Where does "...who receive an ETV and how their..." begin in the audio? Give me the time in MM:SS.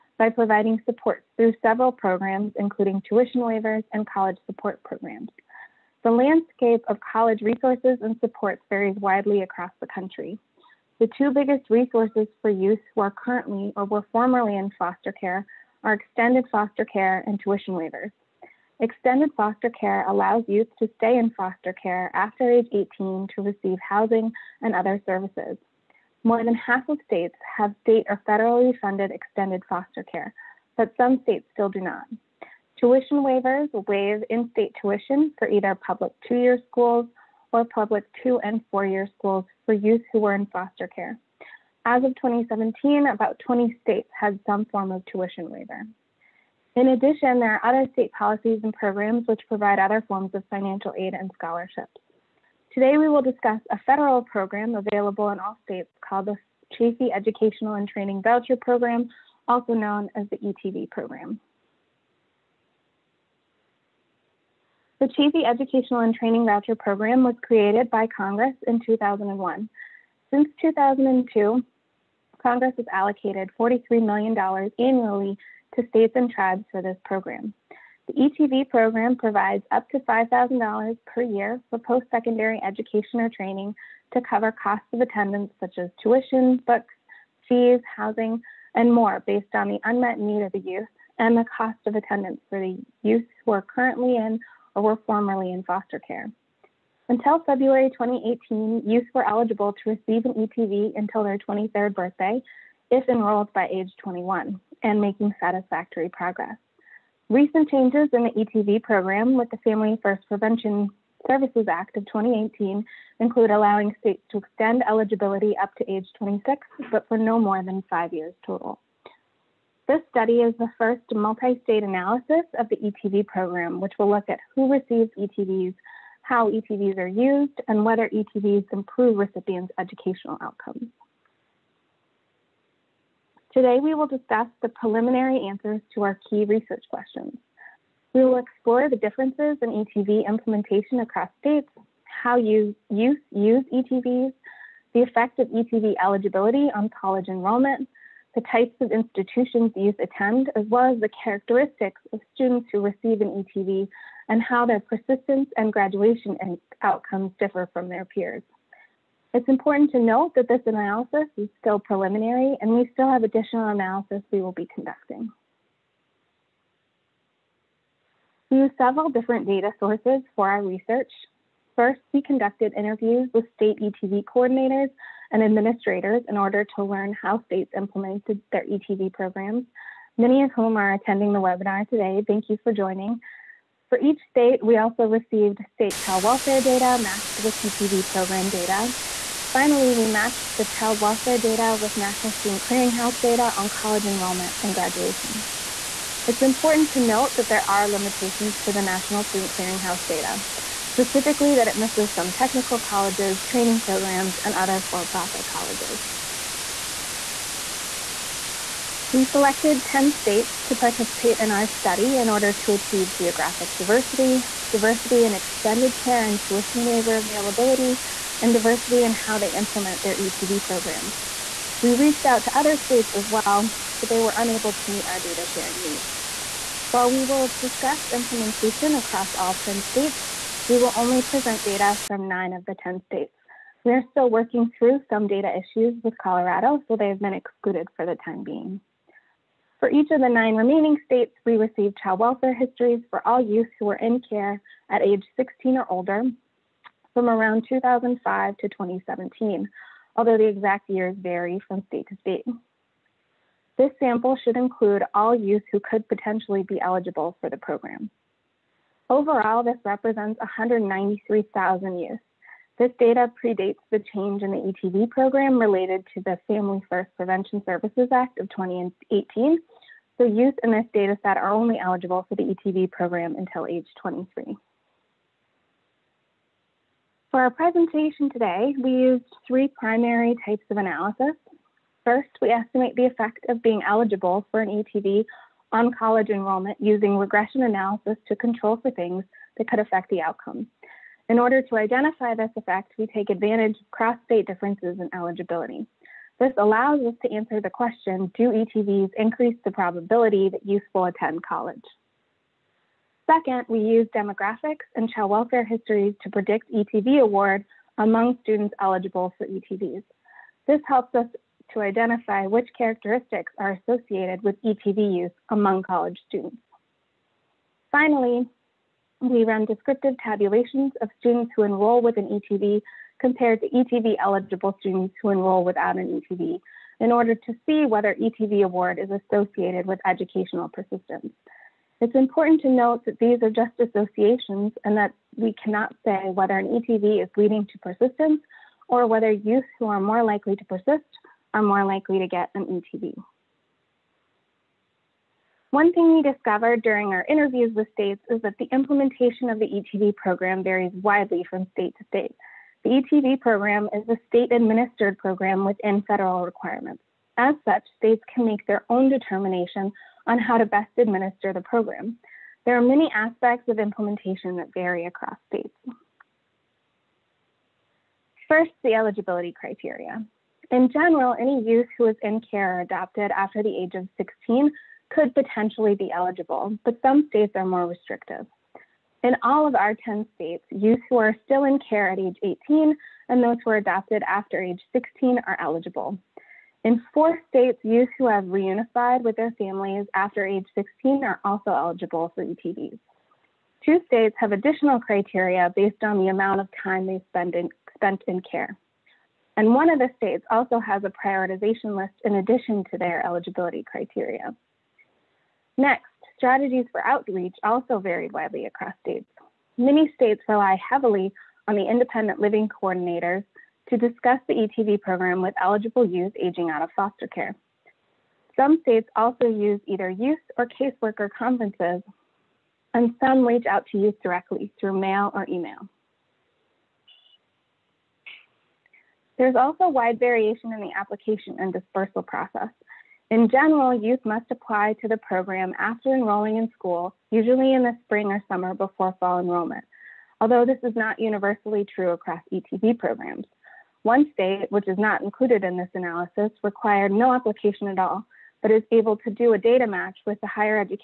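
02:32.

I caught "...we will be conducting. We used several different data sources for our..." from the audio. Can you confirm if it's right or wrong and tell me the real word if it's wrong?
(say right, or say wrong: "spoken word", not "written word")
right.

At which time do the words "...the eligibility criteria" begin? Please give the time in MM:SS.
06:08.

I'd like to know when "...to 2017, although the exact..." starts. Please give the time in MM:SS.
04:08.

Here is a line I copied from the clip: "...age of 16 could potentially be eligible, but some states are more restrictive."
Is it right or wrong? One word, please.
right.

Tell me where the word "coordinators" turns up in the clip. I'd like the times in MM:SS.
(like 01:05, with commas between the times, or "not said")
02:54, 06:52.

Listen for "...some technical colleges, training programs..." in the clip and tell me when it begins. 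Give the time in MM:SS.
03:22.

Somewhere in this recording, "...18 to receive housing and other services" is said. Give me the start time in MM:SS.
00:22.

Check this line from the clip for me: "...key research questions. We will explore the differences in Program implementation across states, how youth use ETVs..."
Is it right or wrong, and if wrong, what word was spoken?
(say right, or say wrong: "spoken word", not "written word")
wrong: "ETV", not "Program".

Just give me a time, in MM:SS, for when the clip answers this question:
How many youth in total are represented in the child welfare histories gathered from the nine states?
04:20.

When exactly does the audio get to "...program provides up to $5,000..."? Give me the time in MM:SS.
01:18.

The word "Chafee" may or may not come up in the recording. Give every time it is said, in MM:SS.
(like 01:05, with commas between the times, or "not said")
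00:56, 01:05.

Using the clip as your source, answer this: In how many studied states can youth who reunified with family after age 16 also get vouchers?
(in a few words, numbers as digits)
4.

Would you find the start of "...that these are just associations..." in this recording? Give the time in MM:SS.
05:33.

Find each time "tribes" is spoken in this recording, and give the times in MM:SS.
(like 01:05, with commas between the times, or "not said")
01:16.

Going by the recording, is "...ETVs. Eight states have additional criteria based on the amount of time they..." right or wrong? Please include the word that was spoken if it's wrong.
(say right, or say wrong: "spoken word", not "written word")
wrong: "Two", not "Eight".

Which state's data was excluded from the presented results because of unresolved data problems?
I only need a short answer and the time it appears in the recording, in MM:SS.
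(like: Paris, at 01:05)
Colorado, at 03:56.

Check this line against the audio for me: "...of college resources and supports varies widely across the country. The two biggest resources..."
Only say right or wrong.
right.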